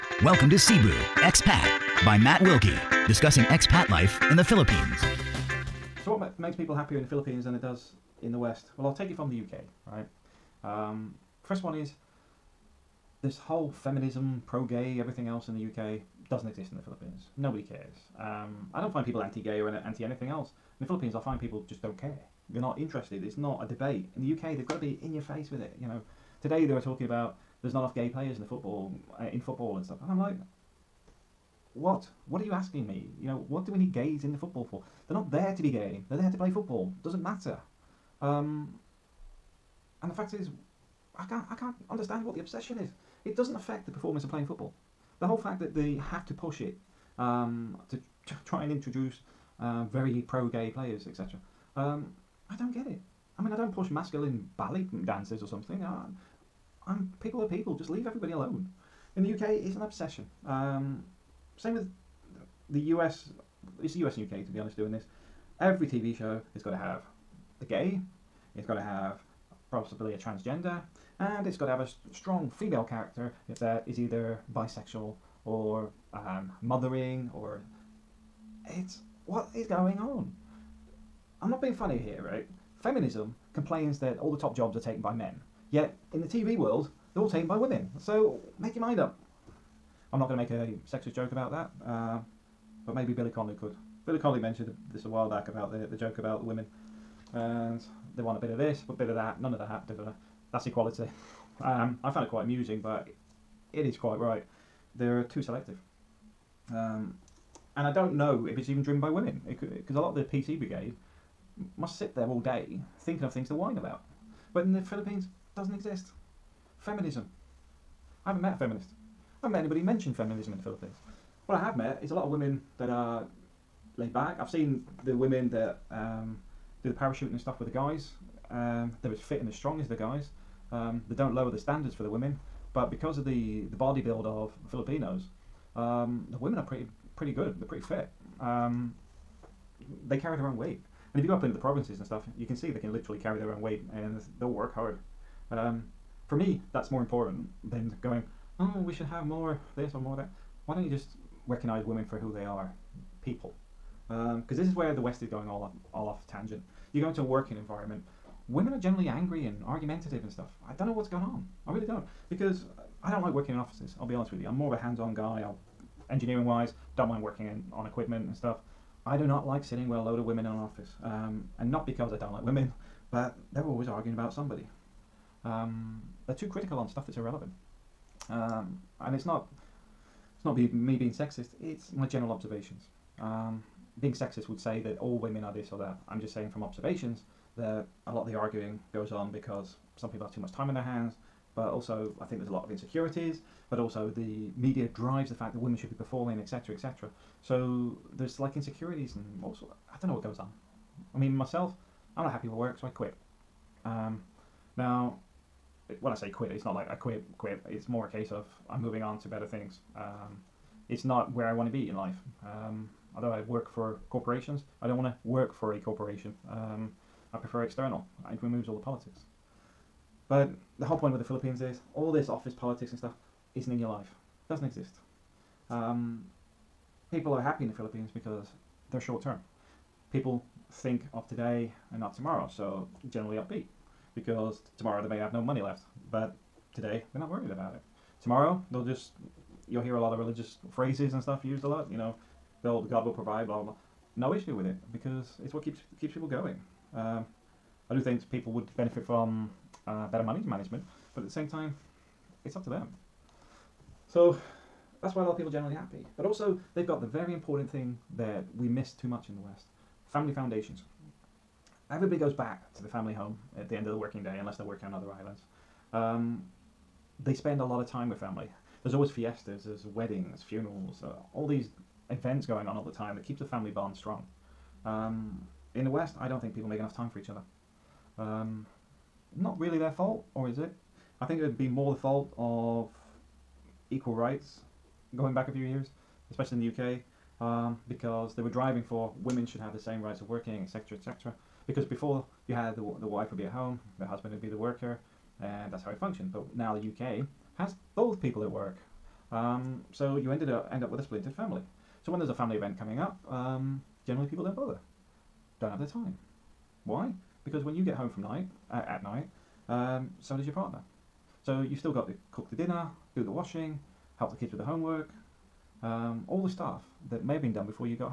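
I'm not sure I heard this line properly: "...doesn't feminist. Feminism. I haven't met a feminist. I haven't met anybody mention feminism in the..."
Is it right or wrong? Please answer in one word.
wrong.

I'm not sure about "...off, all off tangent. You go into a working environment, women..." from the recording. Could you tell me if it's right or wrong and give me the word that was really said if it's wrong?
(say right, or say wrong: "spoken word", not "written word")
right.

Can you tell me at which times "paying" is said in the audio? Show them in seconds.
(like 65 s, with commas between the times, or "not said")
not said.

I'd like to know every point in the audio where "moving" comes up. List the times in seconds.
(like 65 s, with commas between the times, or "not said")
208 s.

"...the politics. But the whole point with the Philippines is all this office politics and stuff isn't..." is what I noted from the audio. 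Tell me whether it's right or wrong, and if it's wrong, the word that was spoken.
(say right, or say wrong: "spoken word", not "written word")
right.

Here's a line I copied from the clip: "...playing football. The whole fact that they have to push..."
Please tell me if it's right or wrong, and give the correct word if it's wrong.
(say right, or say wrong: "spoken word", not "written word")
right.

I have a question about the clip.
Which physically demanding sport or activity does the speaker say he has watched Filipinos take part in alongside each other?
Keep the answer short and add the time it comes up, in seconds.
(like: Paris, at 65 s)
Parachuting, at 126 s.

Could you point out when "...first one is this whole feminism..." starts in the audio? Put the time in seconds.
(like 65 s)
11 s.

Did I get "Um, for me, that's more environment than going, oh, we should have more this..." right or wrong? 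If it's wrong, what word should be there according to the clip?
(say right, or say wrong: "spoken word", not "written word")
wrong: "important", not "environment".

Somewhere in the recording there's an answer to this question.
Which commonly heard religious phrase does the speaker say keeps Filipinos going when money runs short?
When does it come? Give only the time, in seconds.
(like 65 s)
242 s.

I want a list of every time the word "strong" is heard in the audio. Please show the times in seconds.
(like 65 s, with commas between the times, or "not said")
72 s, 129 s, 273 s.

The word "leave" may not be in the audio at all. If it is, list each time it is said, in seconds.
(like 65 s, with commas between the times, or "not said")
57 s.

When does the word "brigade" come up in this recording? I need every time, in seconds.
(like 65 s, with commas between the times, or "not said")
110 s.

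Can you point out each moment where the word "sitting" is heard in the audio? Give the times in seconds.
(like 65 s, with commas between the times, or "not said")
169 s.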